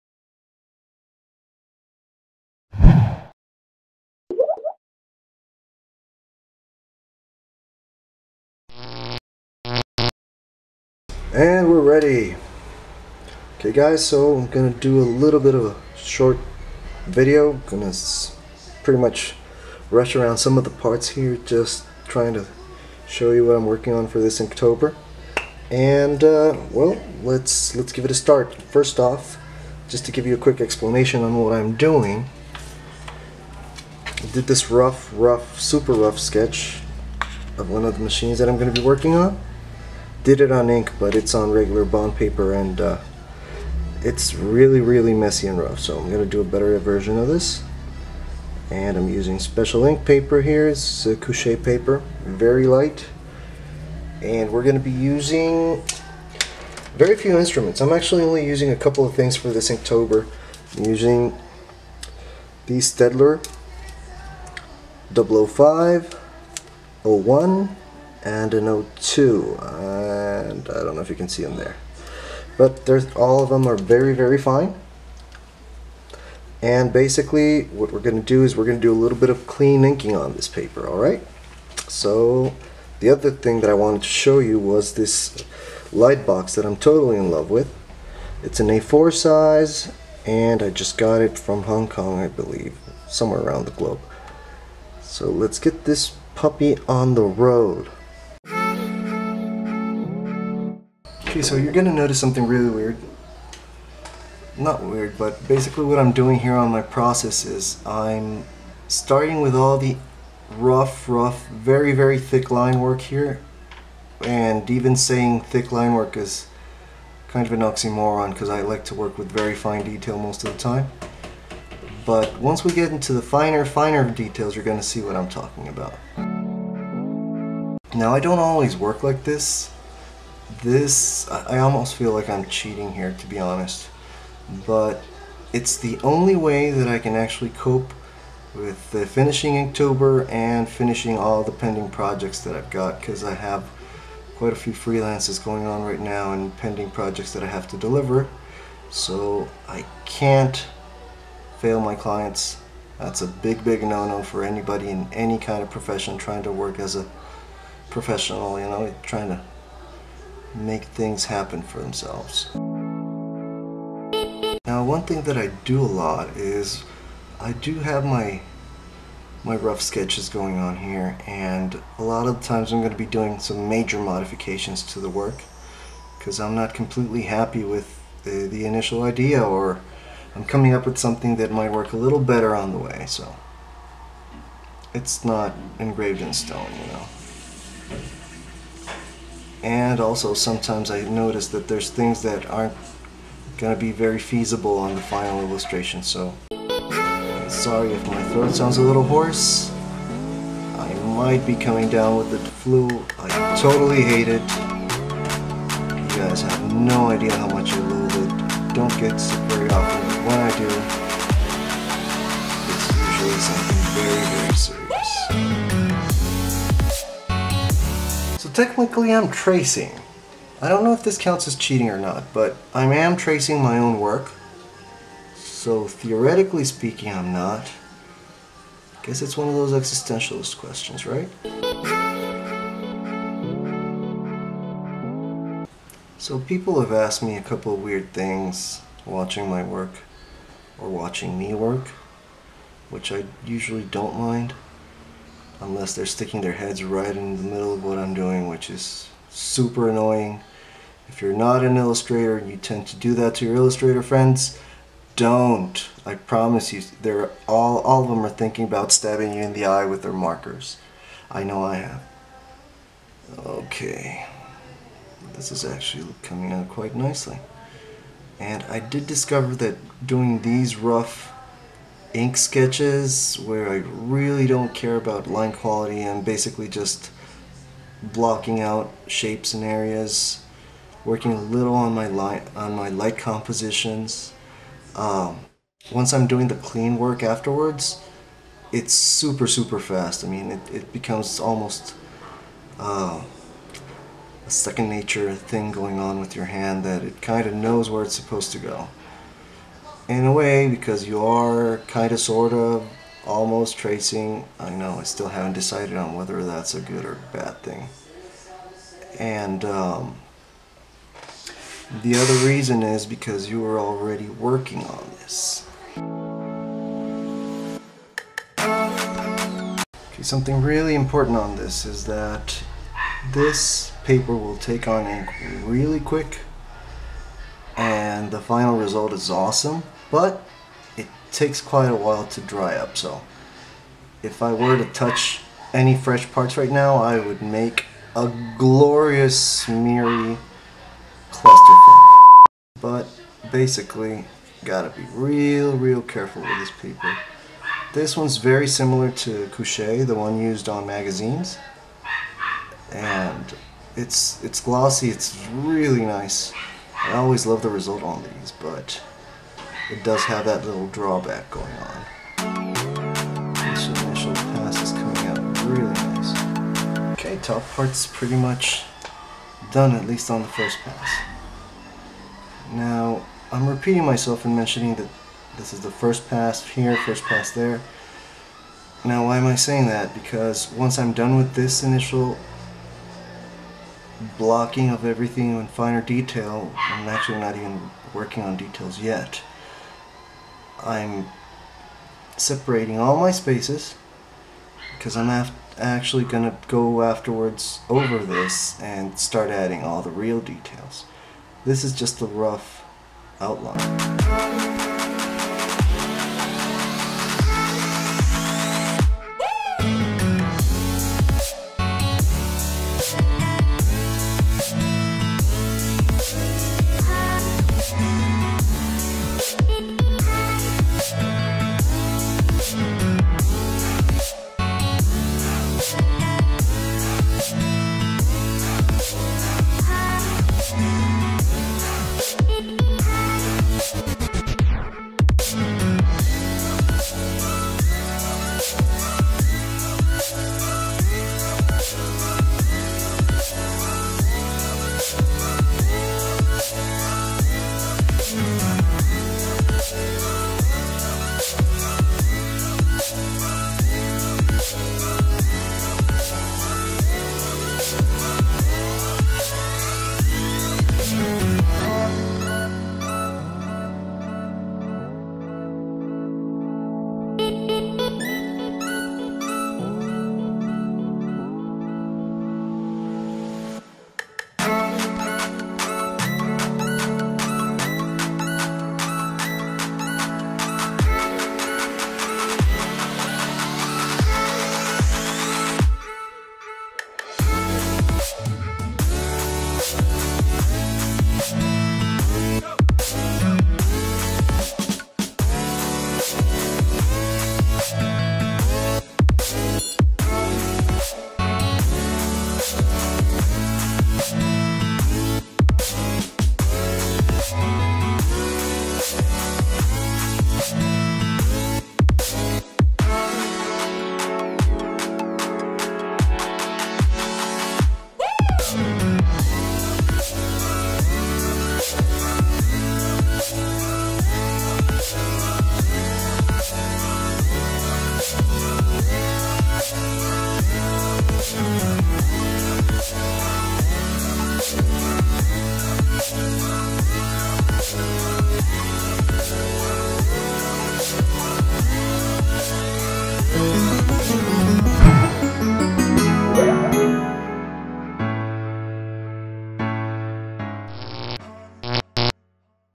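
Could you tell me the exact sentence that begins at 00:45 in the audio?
So I'm going to do a better version of this.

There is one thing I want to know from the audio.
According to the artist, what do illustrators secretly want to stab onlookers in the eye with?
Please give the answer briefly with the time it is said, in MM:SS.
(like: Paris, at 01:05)
their markers, at 04:20.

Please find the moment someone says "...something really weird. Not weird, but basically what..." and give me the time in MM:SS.
01:42.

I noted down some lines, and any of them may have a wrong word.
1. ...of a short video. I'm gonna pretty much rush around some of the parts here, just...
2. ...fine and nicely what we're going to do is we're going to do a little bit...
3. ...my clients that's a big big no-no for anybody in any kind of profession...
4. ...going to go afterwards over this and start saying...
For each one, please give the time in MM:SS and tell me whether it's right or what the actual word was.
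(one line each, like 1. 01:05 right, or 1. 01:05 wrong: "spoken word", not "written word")
1. 00:15 right
2. 01:14 wrong: "basically", not "nicely"
3. 02:31 right
4. 06:36 wrong: "adding", not "saying".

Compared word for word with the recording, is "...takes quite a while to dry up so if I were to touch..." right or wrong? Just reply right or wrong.
right.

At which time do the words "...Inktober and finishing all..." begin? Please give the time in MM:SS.
02:19.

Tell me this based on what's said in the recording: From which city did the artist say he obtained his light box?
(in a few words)
Hong Kong.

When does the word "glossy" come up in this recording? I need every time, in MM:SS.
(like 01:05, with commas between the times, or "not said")
05:54.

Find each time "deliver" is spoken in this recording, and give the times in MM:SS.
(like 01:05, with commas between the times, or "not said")
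02:27.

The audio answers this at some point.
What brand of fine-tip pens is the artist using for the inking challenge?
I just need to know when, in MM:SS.
01:02.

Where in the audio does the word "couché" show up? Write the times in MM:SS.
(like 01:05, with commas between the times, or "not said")
00:51, 05:49.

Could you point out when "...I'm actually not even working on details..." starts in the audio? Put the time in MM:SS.
06:26.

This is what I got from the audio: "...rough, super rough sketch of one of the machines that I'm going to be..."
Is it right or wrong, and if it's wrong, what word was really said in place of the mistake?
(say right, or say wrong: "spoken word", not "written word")
right.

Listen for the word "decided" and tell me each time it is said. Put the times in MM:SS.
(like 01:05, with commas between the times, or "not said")
05:05.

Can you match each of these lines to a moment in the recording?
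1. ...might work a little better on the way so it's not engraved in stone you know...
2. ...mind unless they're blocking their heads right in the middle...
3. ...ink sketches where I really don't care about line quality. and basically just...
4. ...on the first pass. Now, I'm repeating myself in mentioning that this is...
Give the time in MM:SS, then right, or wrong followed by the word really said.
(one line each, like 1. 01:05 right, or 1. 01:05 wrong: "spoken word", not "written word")
1. 03:01 right
2. 04:04 wrong: "sticking", not "blocking"
3. 04:32 right
4. 06:10 right.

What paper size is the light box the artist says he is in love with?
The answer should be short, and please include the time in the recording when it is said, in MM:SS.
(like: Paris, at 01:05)
A4, at 01:28.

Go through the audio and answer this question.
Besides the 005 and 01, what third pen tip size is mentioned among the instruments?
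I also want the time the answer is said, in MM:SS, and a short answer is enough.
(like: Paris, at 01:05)
02, at 01:08.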